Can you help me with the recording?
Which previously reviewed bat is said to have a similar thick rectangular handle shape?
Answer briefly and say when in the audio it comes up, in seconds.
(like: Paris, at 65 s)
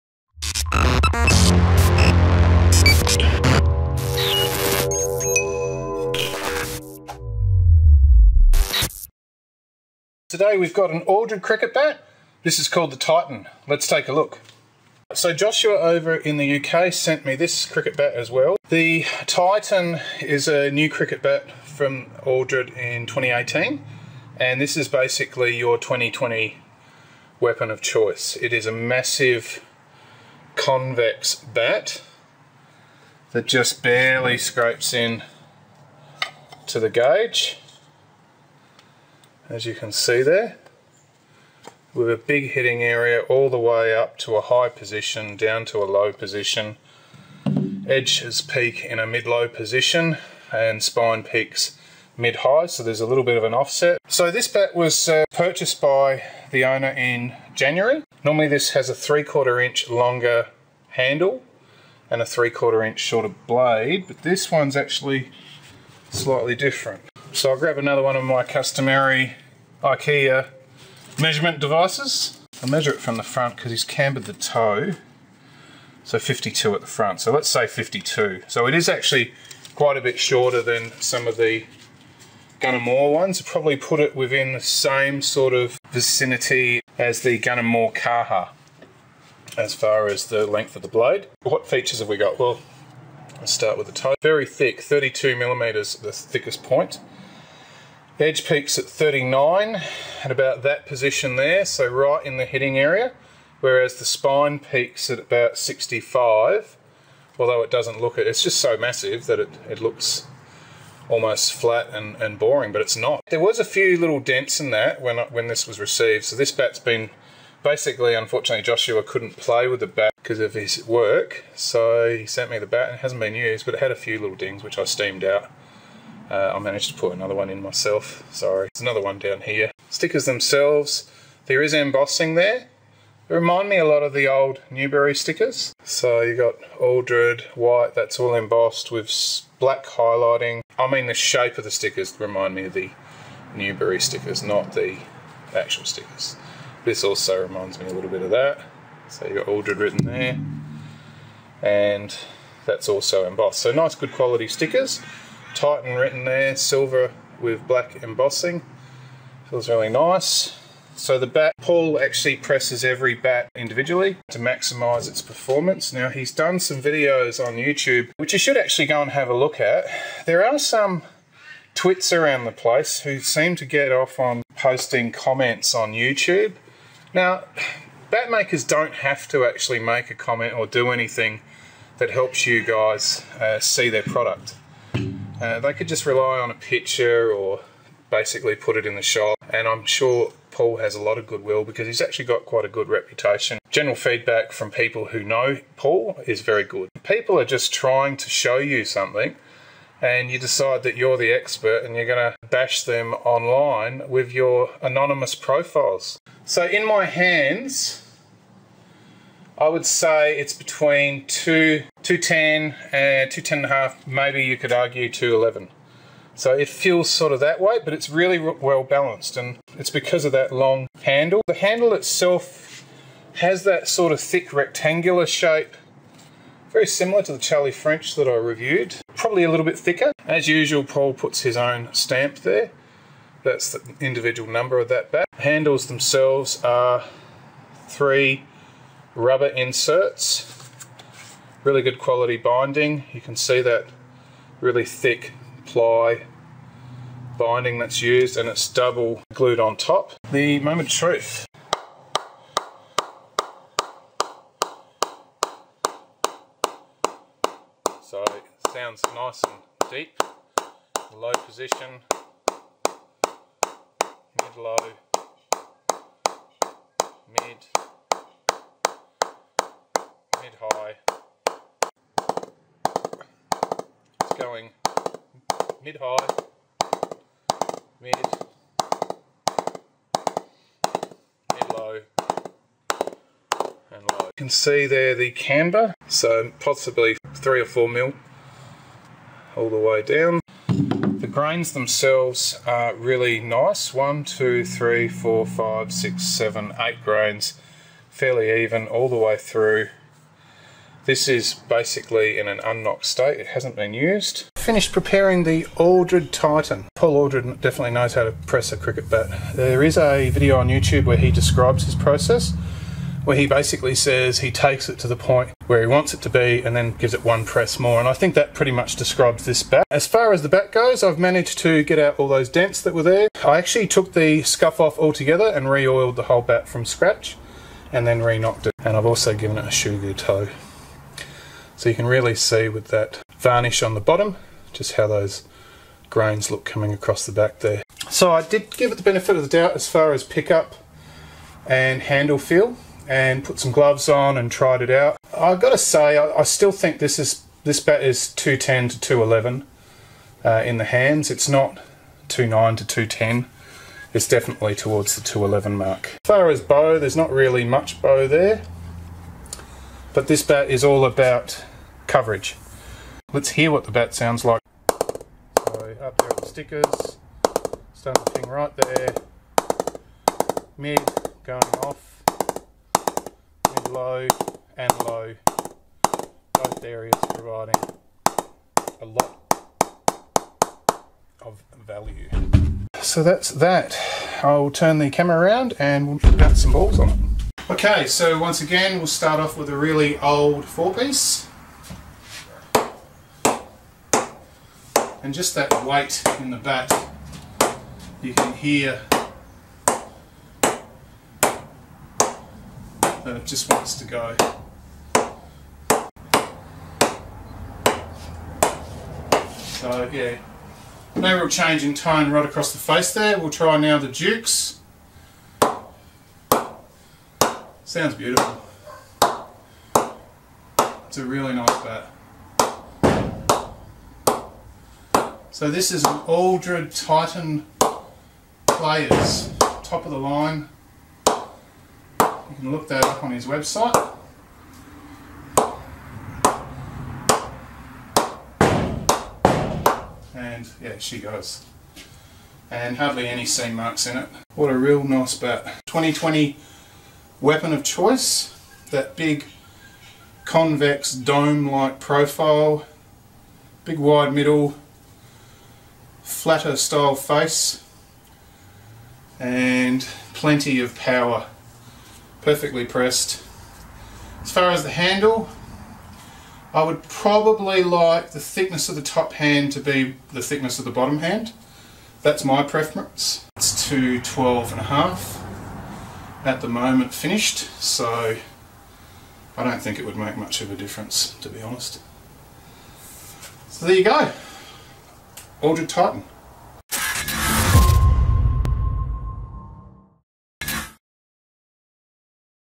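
Charlie French, at 227 s.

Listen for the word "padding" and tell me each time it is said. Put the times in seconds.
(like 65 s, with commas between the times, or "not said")
not said.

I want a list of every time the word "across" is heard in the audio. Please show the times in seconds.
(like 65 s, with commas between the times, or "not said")
336 s, 412 s.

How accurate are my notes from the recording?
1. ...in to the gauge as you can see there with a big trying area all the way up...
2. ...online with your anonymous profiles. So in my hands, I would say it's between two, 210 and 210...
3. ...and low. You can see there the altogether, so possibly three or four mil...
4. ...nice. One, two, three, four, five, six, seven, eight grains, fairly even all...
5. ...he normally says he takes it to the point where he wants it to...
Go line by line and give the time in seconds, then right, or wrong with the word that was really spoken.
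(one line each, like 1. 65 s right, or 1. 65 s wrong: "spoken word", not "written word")
1. 34 s wrong: "hitting", not "trying"
2. 203 s right
3. 283 s wrong: "camber", not "altogether"
4. 293 s right
5. 313 s wrong: "basically", not "normally".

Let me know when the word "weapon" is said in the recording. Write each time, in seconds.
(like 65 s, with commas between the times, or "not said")
27 s, 447 s.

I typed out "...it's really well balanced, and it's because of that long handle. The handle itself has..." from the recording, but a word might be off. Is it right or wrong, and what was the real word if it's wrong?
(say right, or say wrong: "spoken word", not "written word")
right.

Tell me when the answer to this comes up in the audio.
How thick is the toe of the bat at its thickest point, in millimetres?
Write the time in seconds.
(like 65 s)
94 s.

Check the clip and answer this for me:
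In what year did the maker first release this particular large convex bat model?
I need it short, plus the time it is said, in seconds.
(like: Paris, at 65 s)
2018, at 23 s.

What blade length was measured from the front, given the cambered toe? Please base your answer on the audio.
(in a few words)
52.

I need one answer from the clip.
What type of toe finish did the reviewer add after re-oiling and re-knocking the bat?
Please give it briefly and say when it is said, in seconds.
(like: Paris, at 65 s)
sugar toe, at 329 s.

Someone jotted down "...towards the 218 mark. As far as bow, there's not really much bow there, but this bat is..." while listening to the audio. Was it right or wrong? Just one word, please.
wrong.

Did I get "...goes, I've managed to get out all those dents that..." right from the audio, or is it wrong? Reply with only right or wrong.
right.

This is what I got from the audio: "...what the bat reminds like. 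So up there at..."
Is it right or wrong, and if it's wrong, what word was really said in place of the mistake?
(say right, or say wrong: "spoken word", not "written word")
wrong: "sounds", not "reminds".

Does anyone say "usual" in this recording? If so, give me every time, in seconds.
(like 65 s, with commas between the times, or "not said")
230 s.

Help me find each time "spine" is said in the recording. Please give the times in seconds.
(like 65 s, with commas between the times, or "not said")
50 s, 104 s.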